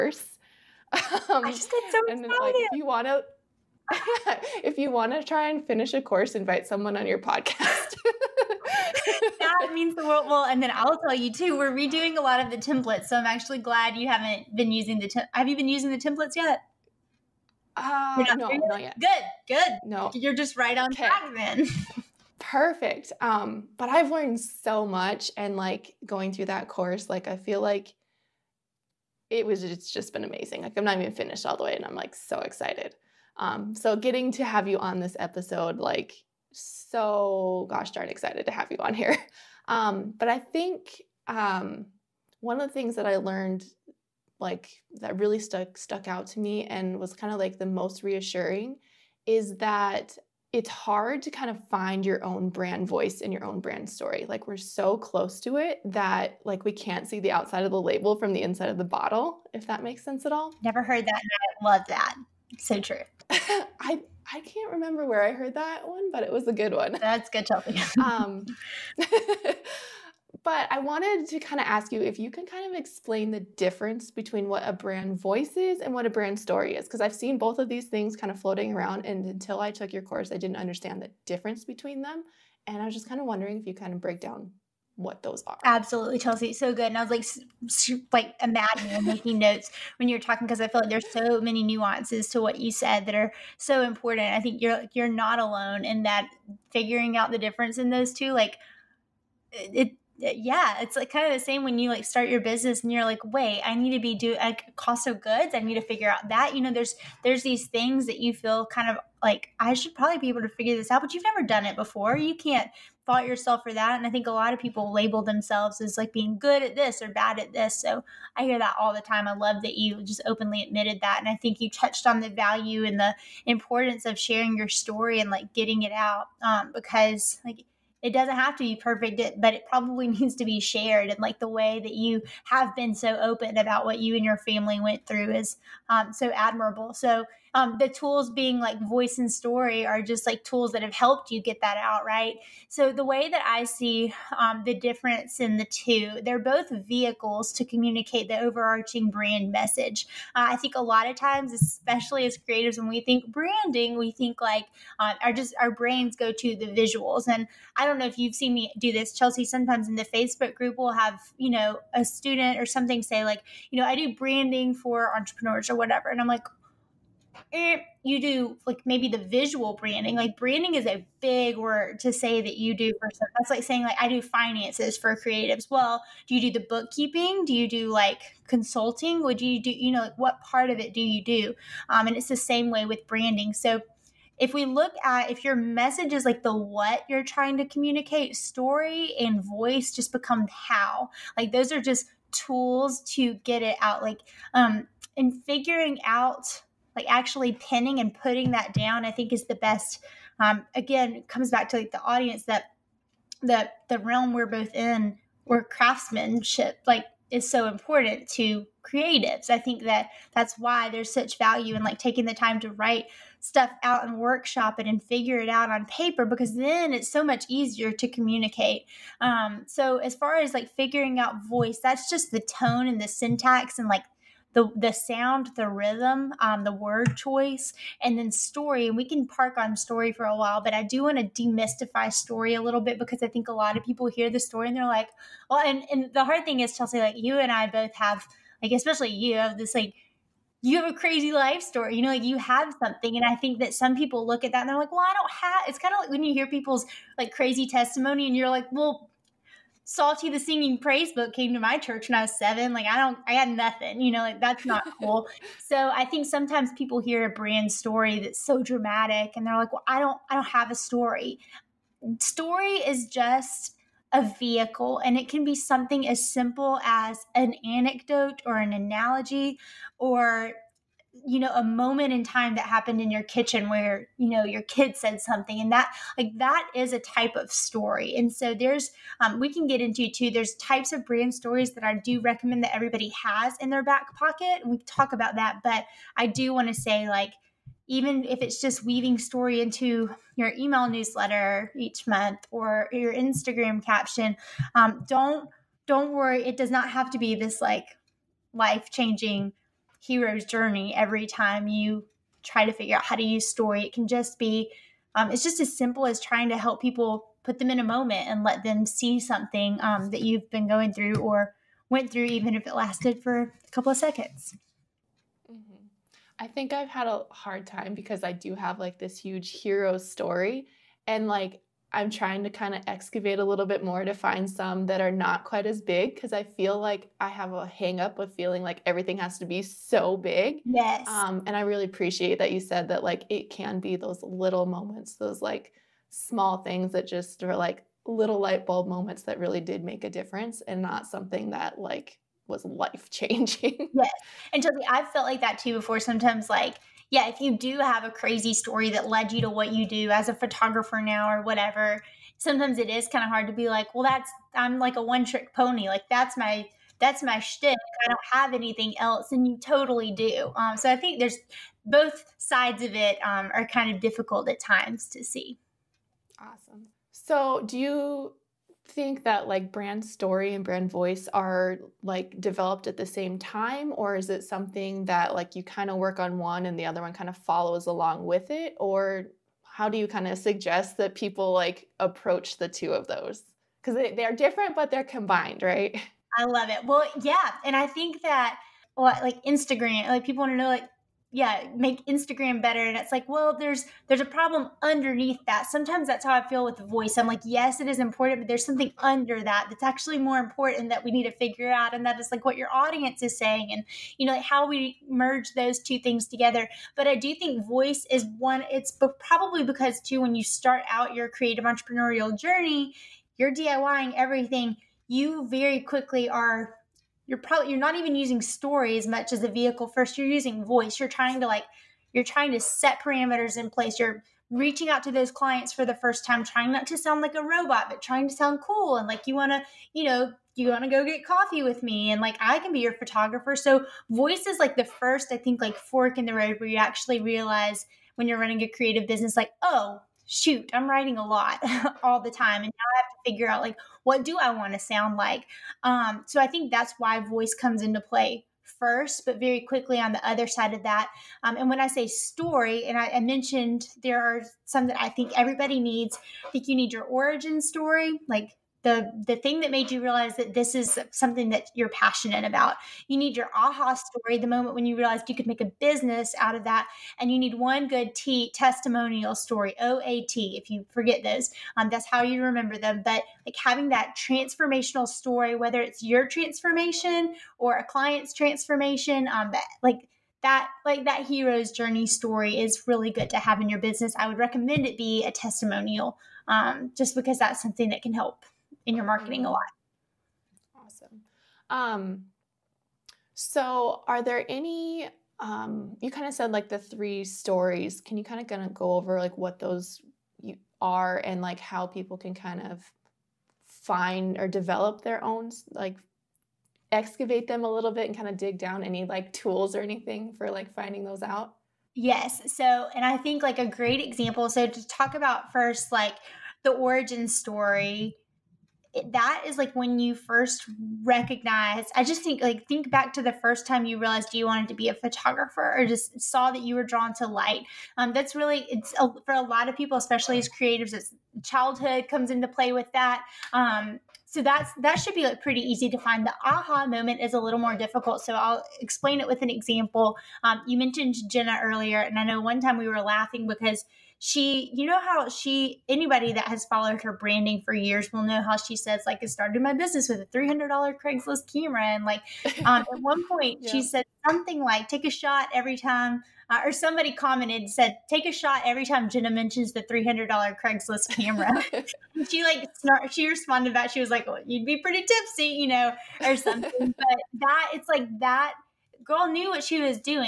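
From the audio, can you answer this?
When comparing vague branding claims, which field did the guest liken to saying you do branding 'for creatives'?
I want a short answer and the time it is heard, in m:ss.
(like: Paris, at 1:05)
Finances, at 2:54.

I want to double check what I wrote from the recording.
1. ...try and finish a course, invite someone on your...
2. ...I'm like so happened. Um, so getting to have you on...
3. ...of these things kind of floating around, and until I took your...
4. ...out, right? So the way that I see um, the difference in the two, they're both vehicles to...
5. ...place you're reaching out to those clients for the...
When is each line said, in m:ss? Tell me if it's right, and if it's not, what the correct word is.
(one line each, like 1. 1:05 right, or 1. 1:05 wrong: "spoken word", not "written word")
1. 0:05 right
2. 0:31 wrong: "excited", not "happened"
3. 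1:17 right
4. 2:21 right
5. 7:03 right.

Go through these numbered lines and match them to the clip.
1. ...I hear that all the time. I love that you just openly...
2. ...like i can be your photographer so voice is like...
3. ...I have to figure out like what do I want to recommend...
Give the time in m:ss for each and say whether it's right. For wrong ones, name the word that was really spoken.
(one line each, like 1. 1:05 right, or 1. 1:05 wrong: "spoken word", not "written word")
1. 1:58 right
2. 7:12 right
3. 7:22 wrong: "sound", not "recommend".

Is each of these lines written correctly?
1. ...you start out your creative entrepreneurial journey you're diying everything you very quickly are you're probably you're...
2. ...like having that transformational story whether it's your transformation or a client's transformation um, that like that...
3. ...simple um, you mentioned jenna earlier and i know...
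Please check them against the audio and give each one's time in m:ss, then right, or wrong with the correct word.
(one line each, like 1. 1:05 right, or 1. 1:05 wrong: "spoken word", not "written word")
1. 6:50 right
2. 7:53 right
3. 8:59 wrong: "example", not "simple".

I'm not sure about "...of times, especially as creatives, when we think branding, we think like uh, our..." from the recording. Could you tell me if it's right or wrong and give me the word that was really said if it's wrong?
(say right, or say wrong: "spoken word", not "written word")
right.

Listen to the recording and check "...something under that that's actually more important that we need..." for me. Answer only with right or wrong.
right.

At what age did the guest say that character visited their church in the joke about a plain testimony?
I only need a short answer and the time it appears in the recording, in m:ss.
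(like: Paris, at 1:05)
7, at 4:12.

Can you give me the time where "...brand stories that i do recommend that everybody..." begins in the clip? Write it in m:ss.
4:41.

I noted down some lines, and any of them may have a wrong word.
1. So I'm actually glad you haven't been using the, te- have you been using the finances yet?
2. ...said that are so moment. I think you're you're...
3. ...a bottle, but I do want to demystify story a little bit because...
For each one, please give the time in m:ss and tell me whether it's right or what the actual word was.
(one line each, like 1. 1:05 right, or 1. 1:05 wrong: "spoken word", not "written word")
1. 0:13 wrong: "templates", not "finances"
2. 1:32 wrong: "important", not "moment"
3. 3:50 wrong: "while", not "bottle".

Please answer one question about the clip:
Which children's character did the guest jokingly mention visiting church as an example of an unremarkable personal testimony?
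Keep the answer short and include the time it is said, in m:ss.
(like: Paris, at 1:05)
Psalty the Singing Praise book, at 4:09.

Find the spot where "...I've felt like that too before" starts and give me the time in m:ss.
5:44.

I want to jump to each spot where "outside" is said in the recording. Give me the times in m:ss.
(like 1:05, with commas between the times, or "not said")
0:57.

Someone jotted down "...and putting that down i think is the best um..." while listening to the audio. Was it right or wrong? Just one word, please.
right.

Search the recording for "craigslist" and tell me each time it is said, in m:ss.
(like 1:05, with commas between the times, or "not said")
9:11, 9:20.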